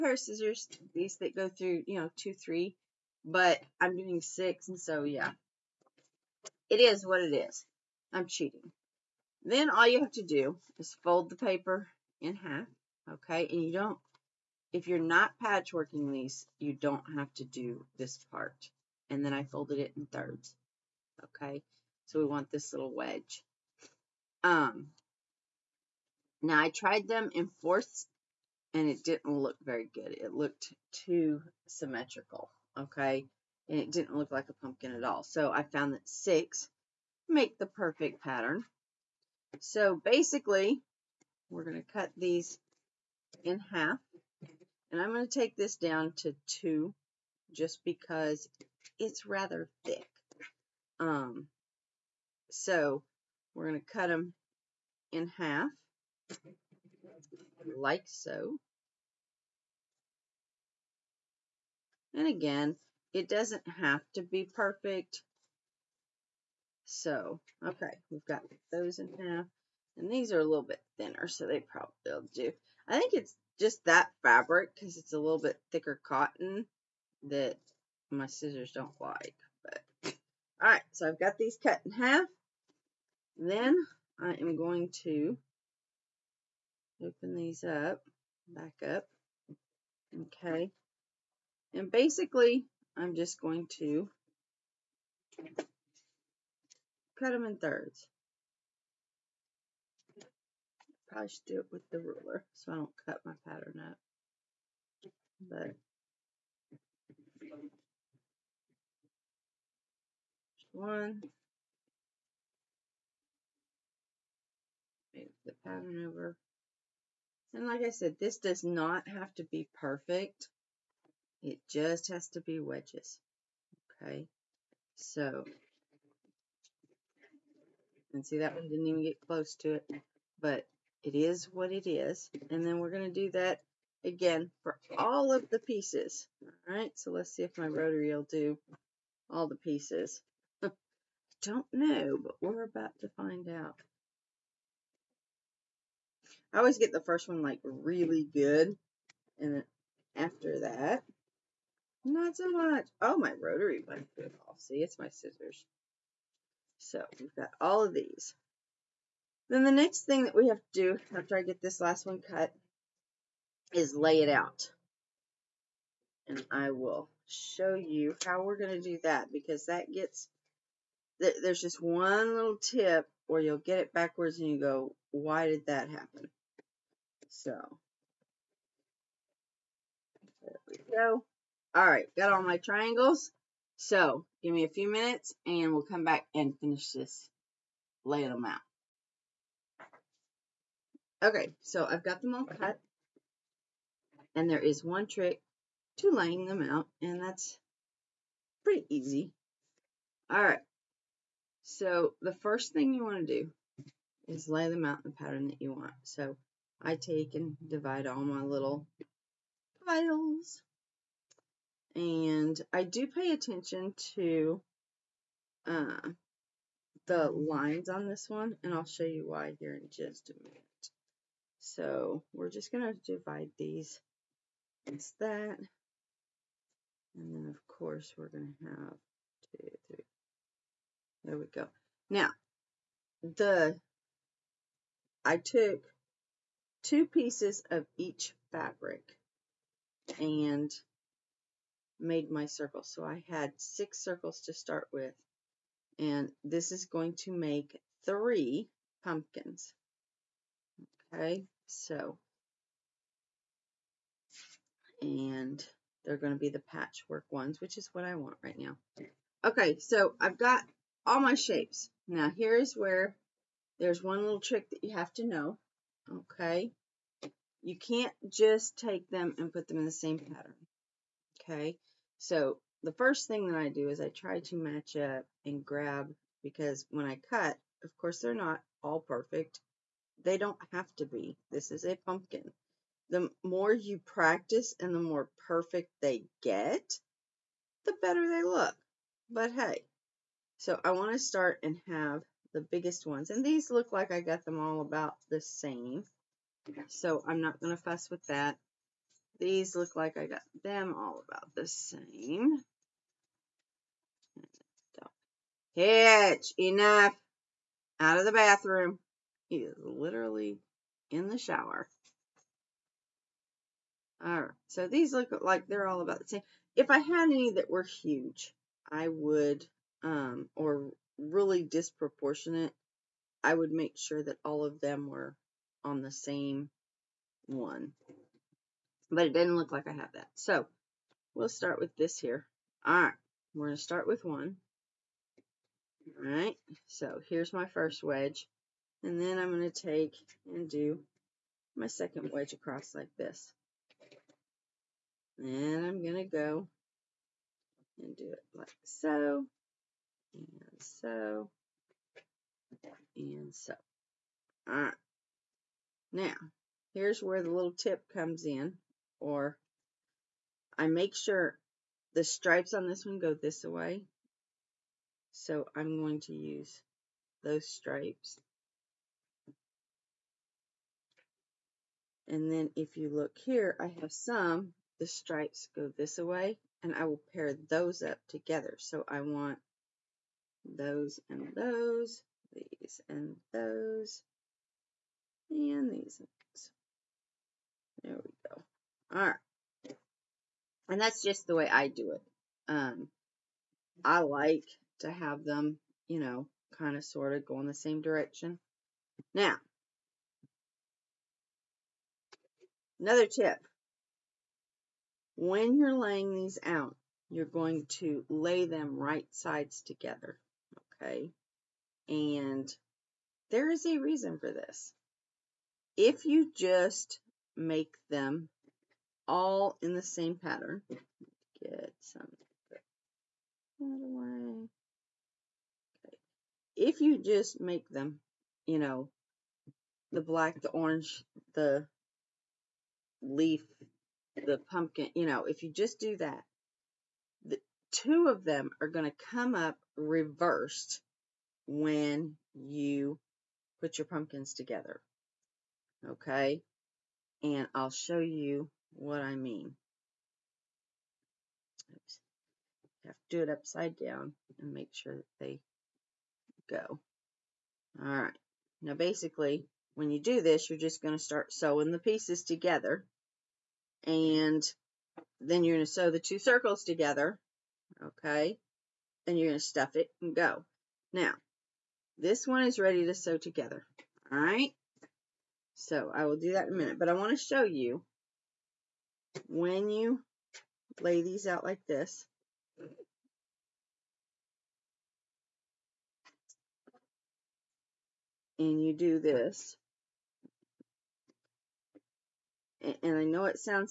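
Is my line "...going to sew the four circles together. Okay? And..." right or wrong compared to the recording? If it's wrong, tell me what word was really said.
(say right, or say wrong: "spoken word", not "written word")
wrong: "two", not "four".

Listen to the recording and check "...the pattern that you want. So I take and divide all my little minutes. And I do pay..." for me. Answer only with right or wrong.
wrong.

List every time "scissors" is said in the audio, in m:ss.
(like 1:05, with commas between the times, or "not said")
0:00, 1:18, 2:35.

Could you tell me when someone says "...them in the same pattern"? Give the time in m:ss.
4:29.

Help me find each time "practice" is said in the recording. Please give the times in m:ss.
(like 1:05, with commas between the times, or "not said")
4:43.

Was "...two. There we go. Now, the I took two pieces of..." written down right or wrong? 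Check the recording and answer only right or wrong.
wrong.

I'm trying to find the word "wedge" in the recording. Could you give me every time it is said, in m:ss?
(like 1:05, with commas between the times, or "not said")
0:22, 2:02, 5:38, 5:42.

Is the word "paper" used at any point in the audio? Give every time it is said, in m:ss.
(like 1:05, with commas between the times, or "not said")
0:11.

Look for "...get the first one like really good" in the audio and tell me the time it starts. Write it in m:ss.
2:26.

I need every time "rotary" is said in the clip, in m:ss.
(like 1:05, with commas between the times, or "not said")
2:17, 2:33.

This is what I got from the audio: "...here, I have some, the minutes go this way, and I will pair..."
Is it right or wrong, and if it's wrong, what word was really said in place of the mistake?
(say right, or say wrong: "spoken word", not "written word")
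wrong: "stripes", not "minutes".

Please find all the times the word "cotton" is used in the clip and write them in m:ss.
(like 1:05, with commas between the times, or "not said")
1:16.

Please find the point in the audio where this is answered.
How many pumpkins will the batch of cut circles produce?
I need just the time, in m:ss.
4:08.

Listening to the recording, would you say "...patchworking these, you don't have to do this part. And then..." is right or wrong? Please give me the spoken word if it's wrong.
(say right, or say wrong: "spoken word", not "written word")
right.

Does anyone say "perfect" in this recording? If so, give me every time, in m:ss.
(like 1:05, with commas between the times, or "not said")
0:37, 1:04, 1:59, 4:39, 4:45.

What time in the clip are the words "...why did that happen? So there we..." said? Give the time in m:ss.
2:55.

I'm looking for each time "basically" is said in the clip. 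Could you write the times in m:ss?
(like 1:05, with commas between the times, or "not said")
0:40, 1:31, 7:38.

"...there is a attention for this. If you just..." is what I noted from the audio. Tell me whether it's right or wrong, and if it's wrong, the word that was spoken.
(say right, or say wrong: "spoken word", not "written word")
wrong: "reason", not "attention".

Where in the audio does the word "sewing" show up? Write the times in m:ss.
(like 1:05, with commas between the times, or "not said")
7:41.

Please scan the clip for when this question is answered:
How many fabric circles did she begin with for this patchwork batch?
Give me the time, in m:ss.
4:03.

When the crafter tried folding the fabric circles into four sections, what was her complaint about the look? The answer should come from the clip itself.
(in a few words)
too symmetrical.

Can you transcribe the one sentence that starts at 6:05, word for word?
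So I'm going to use those stripes.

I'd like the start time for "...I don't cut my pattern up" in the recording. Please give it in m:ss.
1:42.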